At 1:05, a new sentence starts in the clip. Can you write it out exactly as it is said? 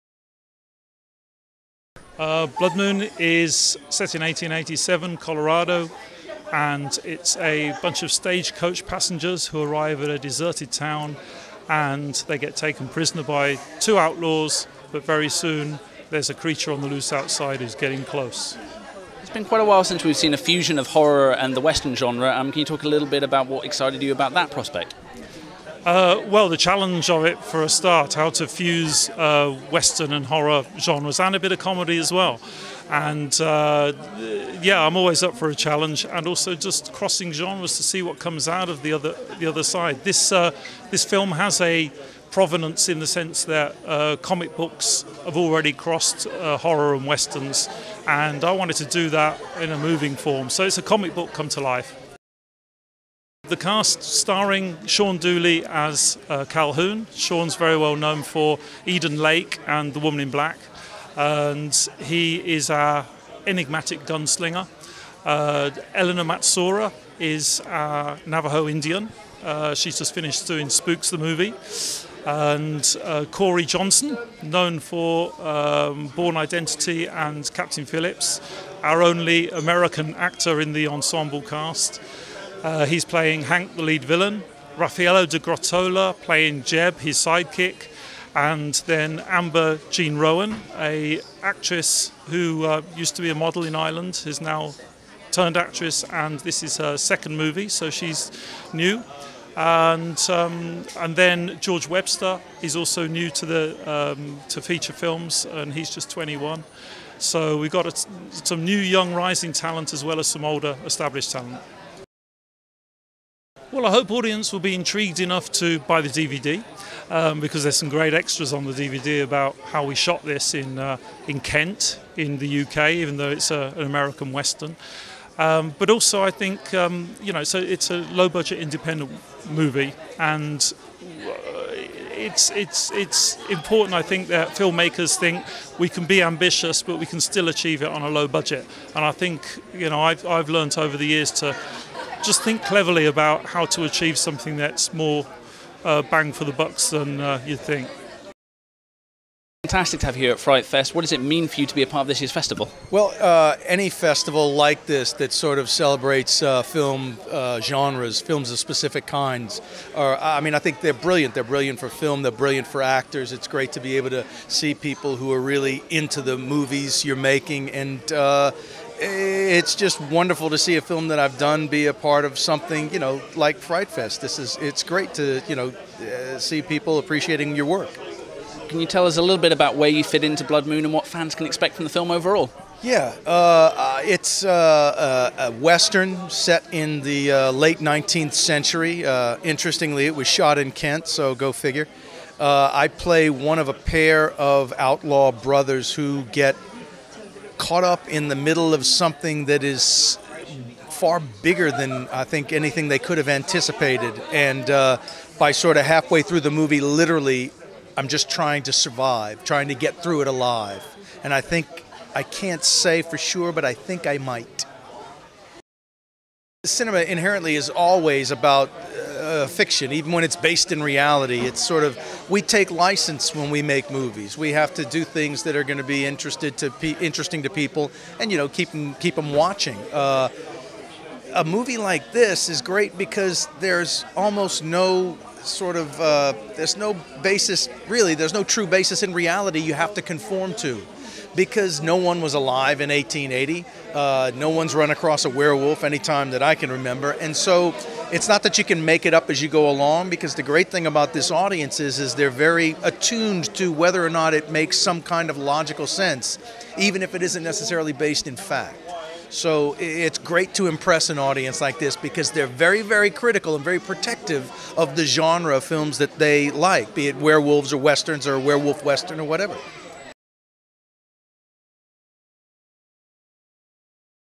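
Uh, Eleanor Matsuura is our Navajo Indian.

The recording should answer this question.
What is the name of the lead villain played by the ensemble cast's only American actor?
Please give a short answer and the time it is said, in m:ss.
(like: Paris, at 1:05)
Hank, at 1:23.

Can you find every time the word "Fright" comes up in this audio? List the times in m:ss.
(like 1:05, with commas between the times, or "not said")
2:30, 2:53.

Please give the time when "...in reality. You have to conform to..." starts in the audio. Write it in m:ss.
3:59.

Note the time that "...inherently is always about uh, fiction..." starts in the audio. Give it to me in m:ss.
3:37.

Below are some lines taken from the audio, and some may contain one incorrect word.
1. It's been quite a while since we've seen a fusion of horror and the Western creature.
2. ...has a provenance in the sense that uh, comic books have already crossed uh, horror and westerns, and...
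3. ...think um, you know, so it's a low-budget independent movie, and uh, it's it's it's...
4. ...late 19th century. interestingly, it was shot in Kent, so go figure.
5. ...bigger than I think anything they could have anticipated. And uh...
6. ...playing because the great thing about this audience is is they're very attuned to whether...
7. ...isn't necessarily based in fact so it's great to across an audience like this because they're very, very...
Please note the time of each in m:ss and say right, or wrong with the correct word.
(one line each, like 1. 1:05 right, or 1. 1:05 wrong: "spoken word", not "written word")
1. 0:19 wrong: "genre", not "creature"
2. 0:41 right
3. 2:06 right
4. 3:07 right
5. 3:21 right
6. 4:09 wrong: "along", not "playing"
7. 4:17 wrong: "impress", not "across".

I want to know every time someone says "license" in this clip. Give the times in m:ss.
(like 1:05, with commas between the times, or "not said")
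3:42.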